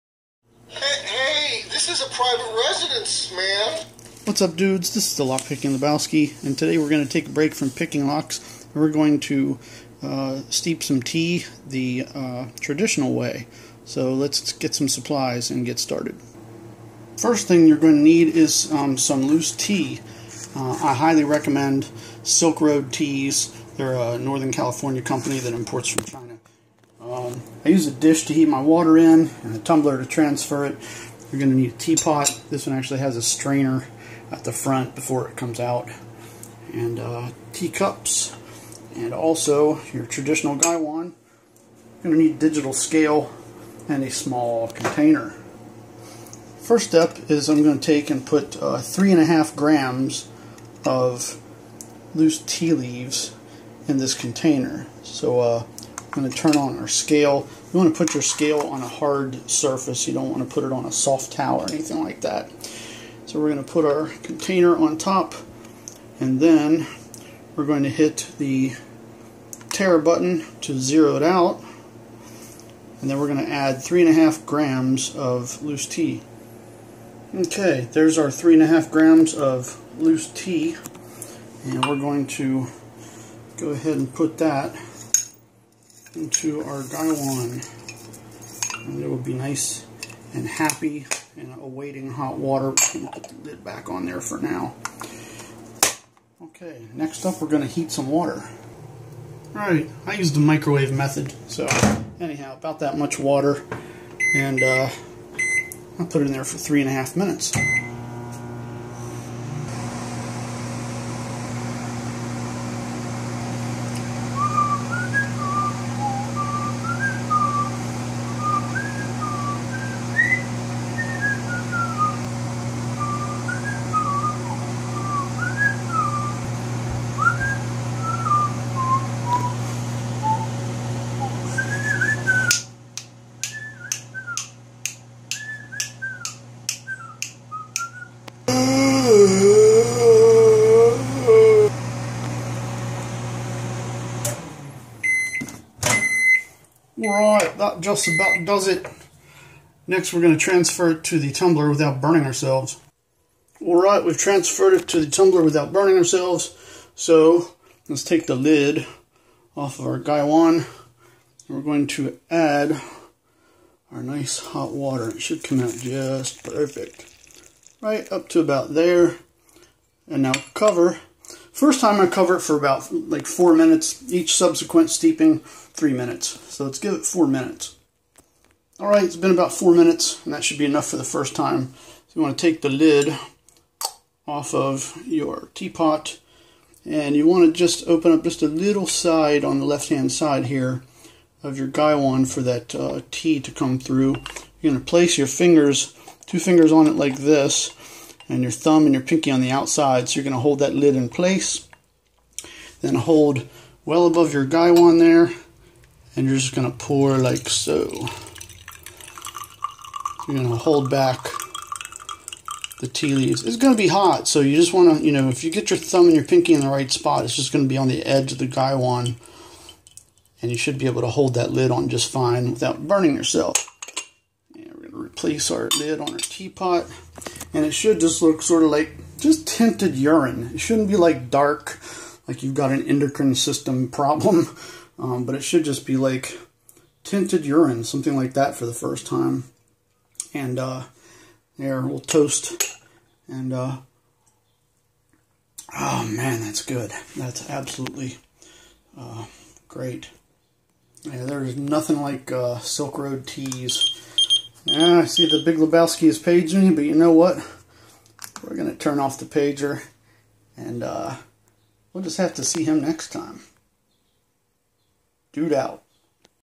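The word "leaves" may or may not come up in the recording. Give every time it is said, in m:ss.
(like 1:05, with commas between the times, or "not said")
0:52, 3:33.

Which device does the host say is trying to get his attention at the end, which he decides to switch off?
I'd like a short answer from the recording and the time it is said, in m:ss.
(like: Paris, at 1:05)
pager, at 4:19.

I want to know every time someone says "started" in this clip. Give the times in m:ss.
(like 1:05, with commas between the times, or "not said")
0:15.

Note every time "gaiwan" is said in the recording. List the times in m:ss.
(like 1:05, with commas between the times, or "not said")
0:40, 1:26, 2:39, 3:11, 3:24, 3:38.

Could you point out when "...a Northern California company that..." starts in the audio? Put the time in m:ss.
0:23.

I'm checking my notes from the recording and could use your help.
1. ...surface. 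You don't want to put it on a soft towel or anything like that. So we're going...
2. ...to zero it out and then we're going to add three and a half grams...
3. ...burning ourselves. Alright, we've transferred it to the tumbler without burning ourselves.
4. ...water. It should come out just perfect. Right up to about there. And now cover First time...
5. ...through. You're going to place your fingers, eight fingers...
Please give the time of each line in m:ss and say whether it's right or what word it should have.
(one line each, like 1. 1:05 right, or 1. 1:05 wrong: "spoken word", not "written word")
1. 0:59 right
2. 1:10 right
3. 2:31 right
4. 2:44 right
5. 3:13 wrong: "two", not "eight".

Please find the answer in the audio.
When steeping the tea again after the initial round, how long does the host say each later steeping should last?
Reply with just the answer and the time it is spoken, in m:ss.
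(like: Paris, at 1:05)
3 minutes, at 2:55.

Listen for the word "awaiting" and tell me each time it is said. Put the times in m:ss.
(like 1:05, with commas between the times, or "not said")
1:31.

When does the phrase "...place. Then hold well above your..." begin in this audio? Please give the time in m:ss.
3:21.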